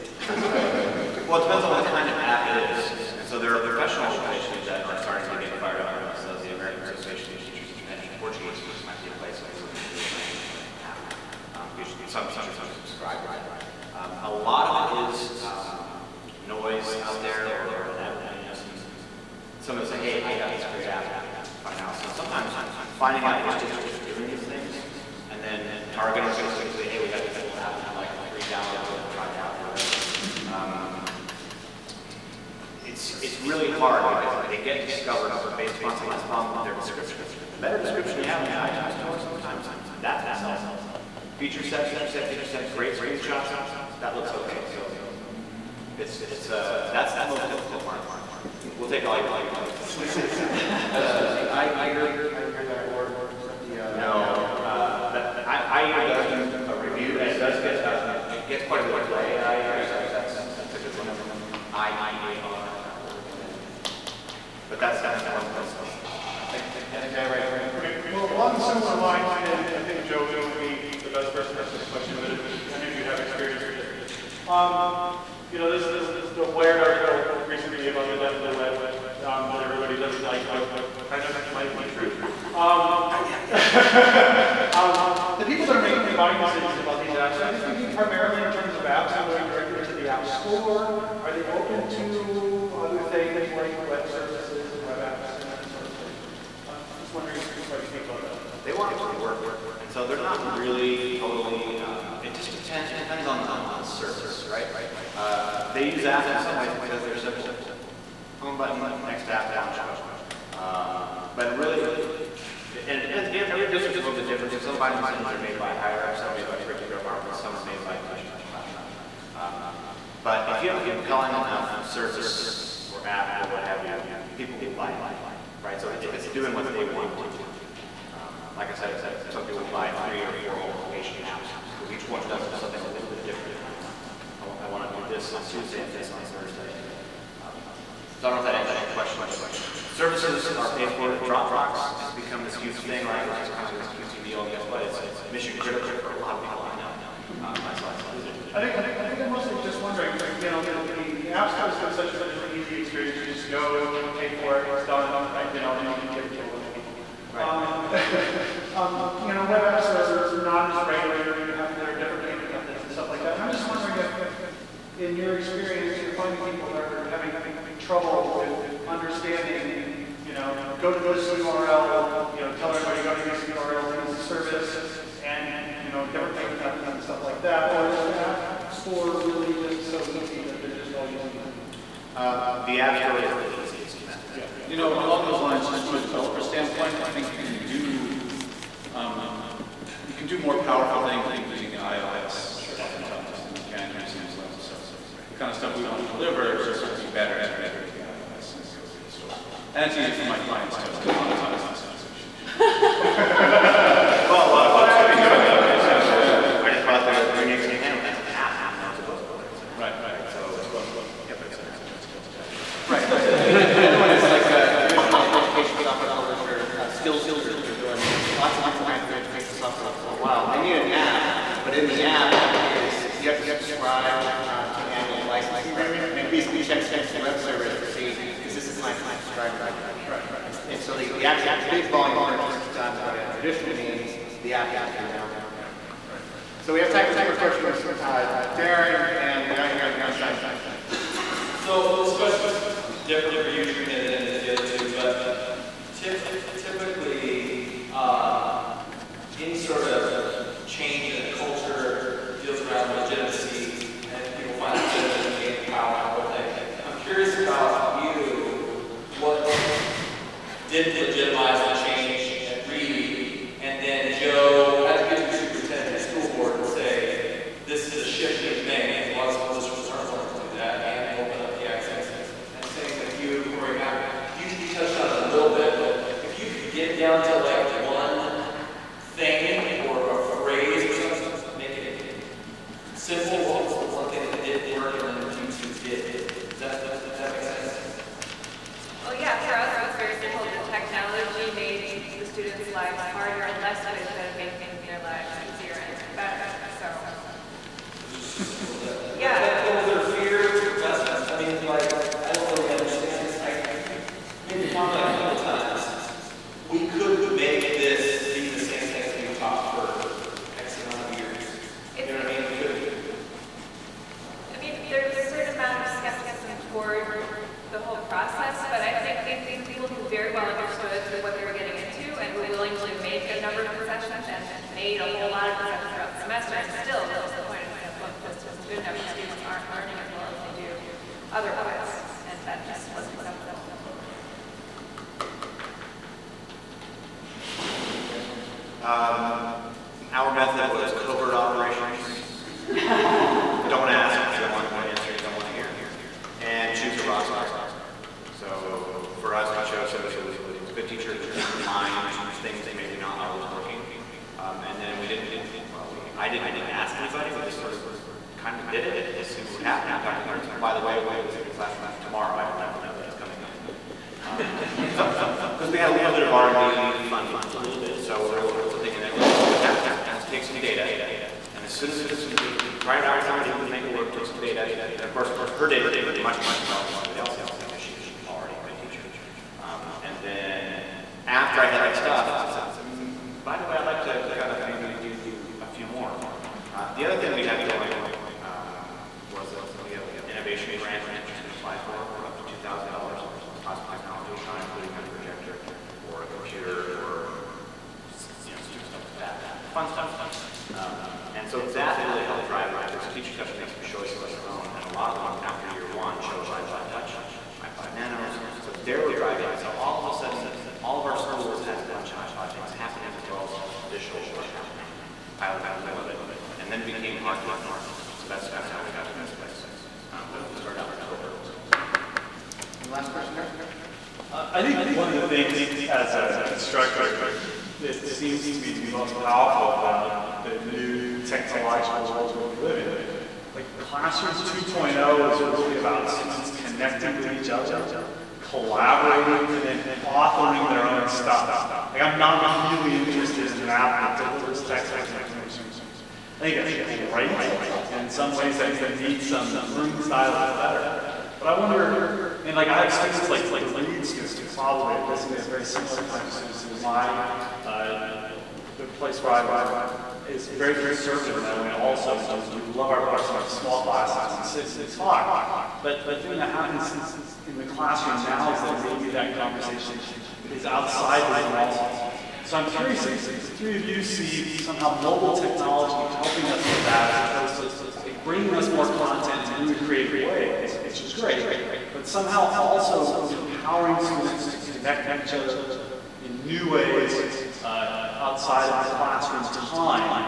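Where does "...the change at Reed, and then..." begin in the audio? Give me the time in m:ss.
4:21.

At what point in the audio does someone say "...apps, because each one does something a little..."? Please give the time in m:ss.
2:11.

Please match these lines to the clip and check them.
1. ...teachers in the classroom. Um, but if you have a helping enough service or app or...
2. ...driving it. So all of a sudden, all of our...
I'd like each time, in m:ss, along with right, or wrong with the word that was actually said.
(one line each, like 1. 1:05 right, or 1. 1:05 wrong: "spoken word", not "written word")
1. 1:58 wrong: "compelling", not "helping"
2. 6:49 right.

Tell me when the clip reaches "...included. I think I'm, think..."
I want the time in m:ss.
2:28.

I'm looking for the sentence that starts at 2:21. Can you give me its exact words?
Dropbox has become this huge thing, right?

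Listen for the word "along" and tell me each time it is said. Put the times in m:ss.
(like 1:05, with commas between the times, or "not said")
1:08, 3:04.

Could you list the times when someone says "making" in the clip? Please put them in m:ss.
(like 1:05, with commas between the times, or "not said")
1:25, 4:54.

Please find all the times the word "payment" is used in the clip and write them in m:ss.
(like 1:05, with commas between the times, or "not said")
2:42, 2:56.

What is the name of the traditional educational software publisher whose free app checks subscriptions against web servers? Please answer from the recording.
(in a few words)
Skills Tutor.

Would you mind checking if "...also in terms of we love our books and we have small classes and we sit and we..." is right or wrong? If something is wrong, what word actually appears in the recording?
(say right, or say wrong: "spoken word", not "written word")
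right.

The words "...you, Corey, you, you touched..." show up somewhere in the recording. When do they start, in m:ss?
4:33.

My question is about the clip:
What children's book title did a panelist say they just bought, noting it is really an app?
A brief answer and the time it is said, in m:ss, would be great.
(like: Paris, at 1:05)
Green Eggs and Ham, at 3:27.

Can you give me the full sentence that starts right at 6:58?
So that's kind of how we got to this place.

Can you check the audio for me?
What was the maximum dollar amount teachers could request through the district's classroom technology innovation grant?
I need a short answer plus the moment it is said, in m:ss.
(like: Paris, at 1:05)
$2,000, at 6:32.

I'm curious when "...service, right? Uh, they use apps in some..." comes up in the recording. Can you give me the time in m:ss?
1:43.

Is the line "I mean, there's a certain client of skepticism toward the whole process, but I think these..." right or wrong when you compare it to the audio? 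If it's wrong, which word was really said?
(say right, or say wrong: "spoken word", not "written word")
wrong: "amount", not "client".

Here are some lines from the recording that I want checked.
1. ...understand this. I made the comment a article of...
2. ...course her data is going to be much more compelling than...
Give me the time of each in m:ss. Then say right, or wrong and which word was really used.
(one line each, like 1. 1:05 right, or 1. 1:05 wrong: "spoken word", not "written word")
1. 5:02 wrong: "couple", not "article"
2. 6:15 right.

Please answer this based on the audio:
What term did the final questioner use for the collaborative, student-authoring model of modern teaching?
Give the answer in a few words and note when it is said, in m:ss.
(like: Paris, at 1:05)
Classroom 2.0, at 7:13.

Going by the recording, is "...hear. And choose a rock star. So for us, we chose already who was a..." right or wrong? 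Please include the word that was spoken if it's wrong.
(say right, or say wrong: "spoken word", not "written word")
wrong: "somebody", not "already".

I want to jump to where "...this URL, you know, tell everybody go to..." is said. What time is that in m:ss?
2:51.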